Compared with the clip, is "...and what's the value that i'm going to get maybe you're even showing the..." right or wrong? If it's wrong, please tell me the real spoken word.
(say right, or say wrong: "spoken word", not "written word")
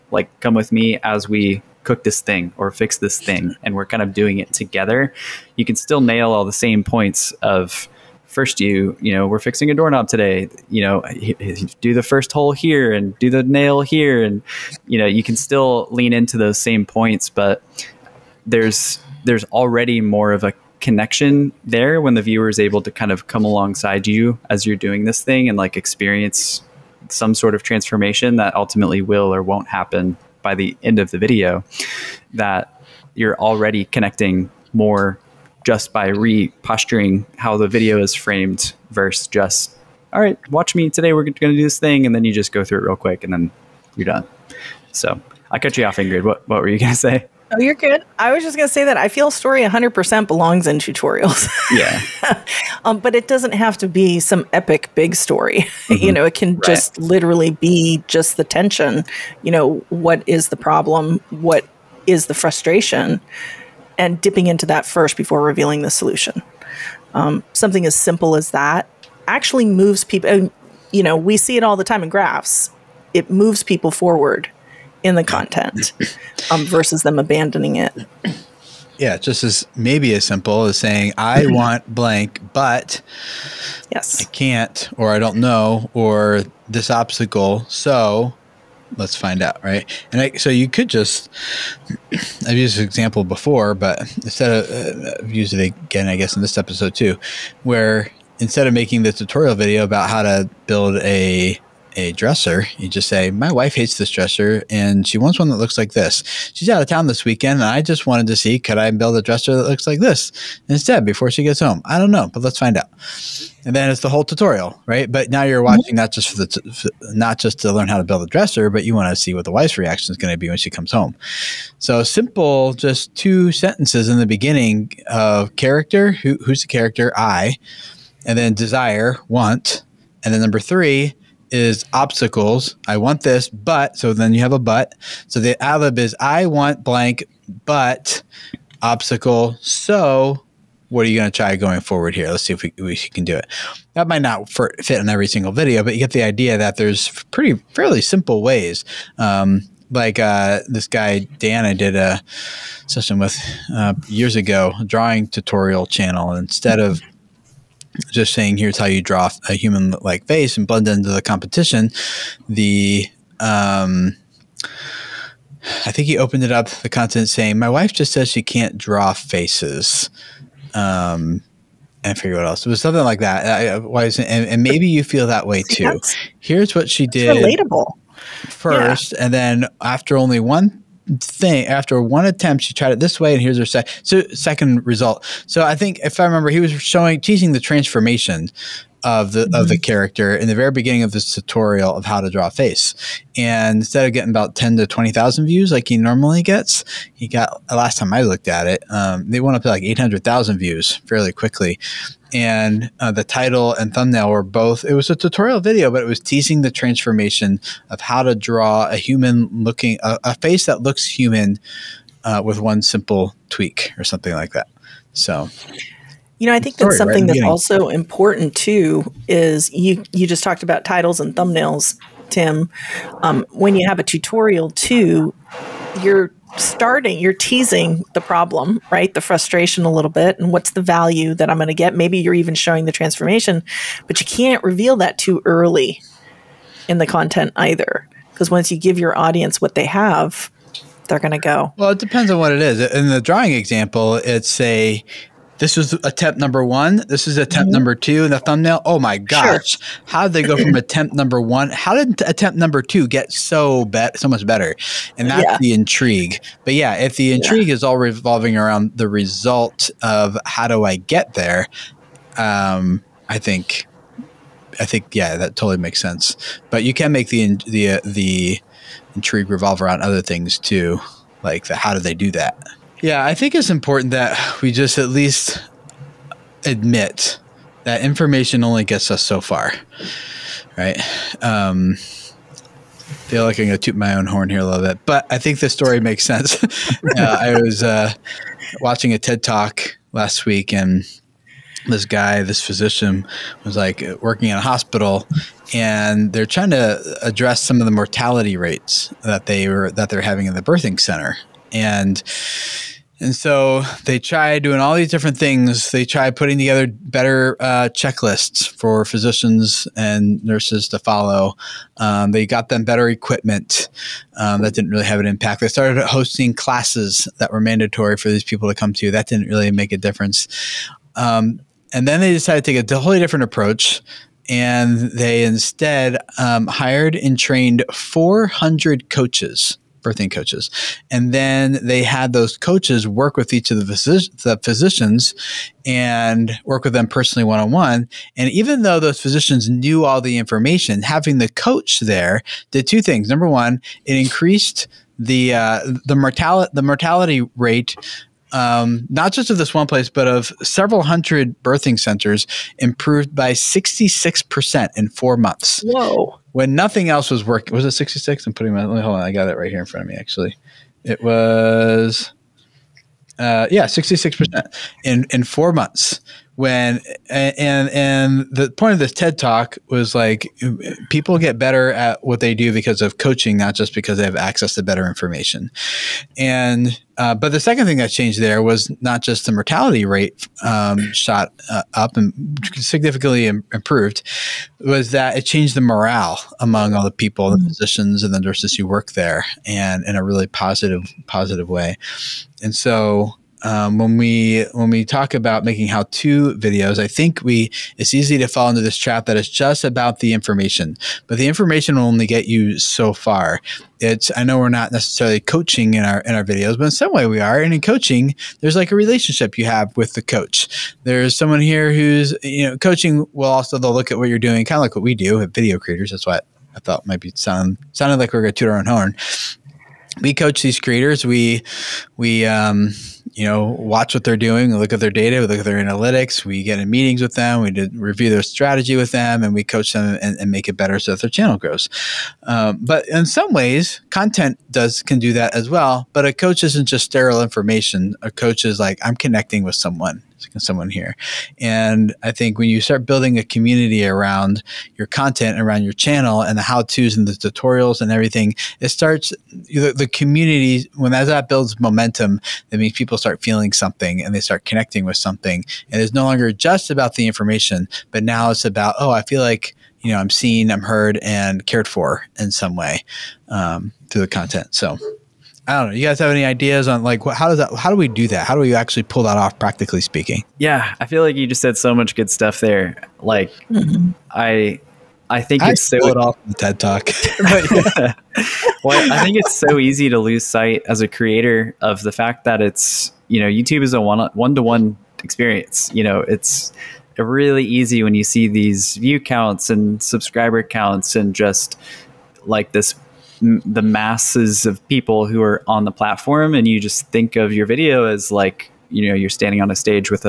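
right.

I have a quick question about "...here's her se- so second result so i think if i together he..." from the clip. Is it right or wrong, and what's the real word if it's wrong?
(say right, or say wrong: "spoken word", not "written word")
wrong: "remember", not "together".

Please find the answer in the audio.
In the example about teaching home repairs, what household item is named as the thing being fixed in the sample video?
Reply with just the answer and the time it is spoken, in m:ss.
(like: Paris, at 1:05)
doorknob, at 0:09.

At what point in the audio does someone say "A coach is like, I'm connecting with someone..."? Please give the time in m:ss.
7:18.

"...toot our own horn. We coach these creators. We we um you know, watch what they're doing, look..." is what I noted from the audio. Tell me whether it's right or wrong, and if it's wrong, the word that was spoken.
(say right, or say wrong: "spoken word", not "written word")
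right.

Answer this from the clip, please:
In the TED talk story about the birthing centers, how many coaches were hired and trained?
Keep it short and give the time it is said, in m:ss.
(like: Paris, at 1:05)
400, at 5:27.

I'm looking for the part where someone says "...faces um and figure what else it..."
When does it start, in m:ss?
2:49.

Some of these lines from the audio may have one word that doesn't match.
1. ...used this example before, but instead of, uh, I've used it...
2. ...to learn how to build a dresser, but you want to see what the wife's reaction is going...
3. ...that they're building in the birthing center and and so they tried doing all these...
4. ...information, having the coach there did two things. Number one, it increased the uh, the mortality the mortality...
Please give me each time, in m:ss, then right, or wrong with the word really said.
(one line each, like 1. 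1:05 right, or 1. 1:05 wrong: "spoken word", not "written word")
1. 1:32 right
2. 1:57 right
3. 4:59 wrong: "having", not "building"
4. 5:40 right.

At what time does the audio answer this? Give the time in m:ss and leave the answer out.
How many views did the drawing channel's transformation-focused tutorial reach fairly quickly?
3:19.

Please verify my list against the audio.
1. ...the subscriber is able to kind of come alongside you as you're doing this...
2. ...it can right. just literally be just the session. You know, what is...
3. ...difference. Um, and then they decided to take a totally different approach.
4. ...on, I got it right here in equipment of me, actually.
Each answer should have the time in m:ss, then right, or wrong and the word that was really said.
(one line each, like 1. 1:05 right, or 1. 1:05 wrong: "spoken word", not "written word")
1. 0:22 wrong: "viewer", not "subscriber"
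2. 0:56 wrong: "tension", not "session"
3. 5:19 right
4. 5:58 wrong: "front", not "equipment".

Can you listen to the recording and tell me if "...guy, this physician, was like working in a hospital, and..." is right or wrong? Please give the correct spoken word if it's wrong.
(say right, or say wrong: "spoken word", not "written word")
right.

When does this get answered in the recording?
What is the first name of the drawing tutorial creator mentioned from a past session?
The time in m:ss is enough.
2:31.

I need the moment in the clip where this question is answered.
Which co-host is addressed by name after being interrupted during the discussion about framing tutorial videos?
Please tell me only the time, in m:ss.
0:45.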